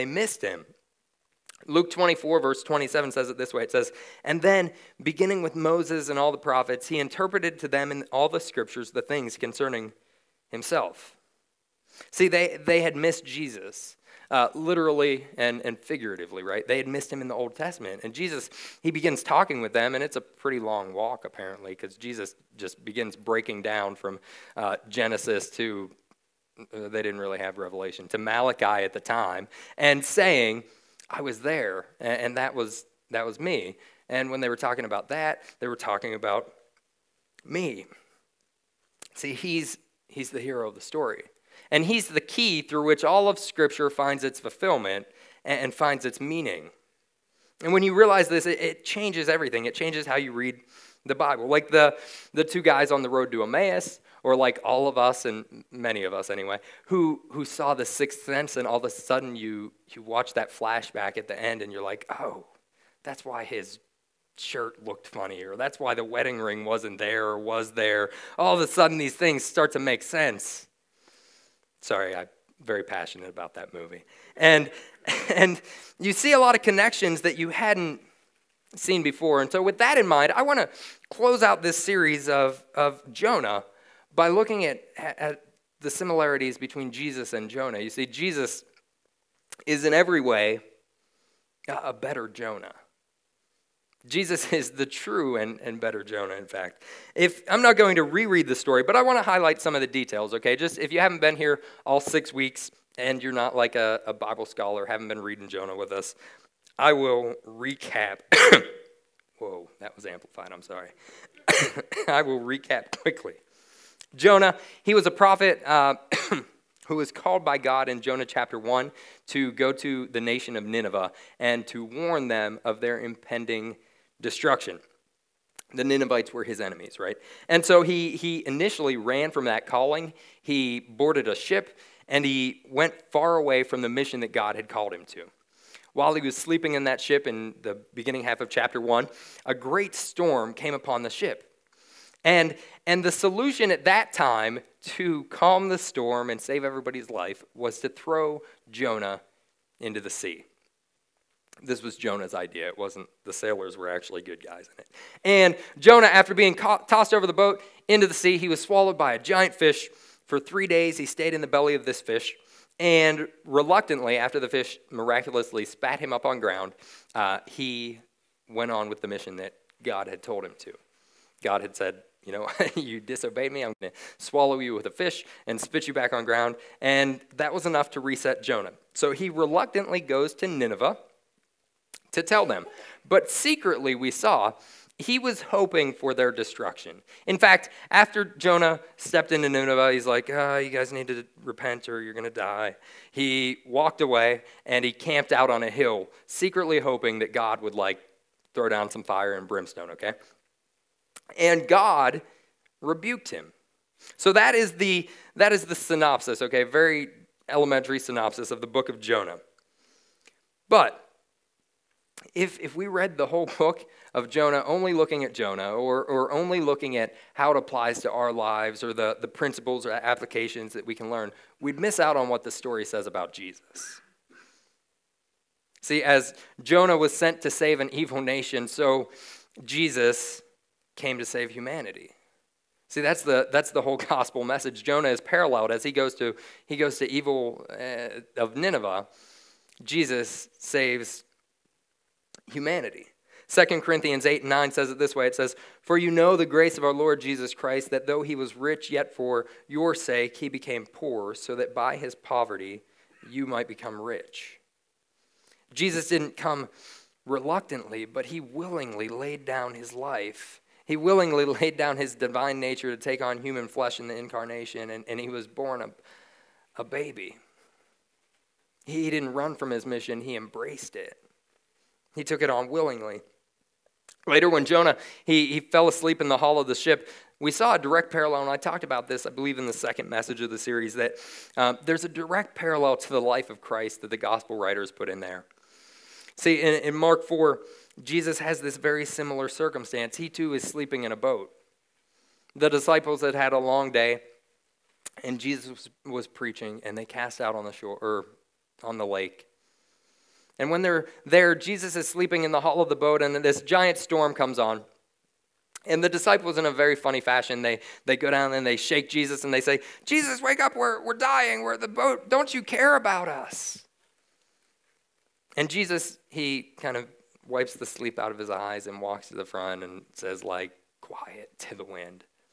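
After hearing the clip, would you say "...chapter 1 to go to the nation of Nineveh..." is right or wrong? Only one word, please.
right.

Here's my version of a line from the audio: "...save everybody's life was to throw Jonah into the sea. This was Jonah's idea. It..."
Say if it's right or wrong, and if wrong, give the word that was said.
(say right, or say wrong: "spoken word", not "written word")
right.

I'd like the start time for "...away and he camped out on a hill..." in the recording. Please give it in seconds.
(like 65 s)
194 s.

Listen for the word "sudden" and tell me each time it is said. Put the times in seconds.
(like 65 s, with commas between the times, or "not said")
58 s, 68 s.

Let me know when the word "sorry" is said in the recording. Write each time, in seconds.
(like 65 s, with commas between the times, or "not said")
71 s, 110 s.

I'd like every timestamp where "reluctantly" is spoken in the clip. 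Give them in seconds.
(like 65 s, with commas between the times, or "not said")
163 s, 179 s, 257 s.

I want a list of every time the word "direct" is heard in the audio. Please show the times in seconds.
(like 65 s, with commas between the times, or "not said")
277 s, 282 s.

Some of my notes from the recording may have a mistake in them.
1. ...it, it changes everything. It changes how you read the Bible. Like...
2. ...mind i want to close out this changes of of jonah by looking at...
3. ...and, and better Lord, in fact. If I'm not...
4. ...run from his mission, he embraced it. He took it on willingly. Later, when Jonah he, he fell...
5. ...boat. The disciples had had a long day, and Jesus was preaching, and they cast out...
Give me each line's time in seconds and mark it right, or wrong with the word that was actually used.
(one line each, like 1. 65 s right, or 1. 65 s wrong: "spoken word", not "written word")
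1. 48 s right
2. 80 s wrong: "series", not "changes"
3. 95 s wrong: "Jonah", not "Lord"
4. 269 s right
5. 291 s right.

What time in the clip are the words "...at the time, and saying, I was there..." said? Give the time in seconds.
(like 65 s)
28 s.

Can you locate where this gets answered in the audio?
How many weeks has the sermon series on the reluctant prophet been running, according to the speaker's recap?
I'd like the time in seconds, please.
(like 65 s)
102 s.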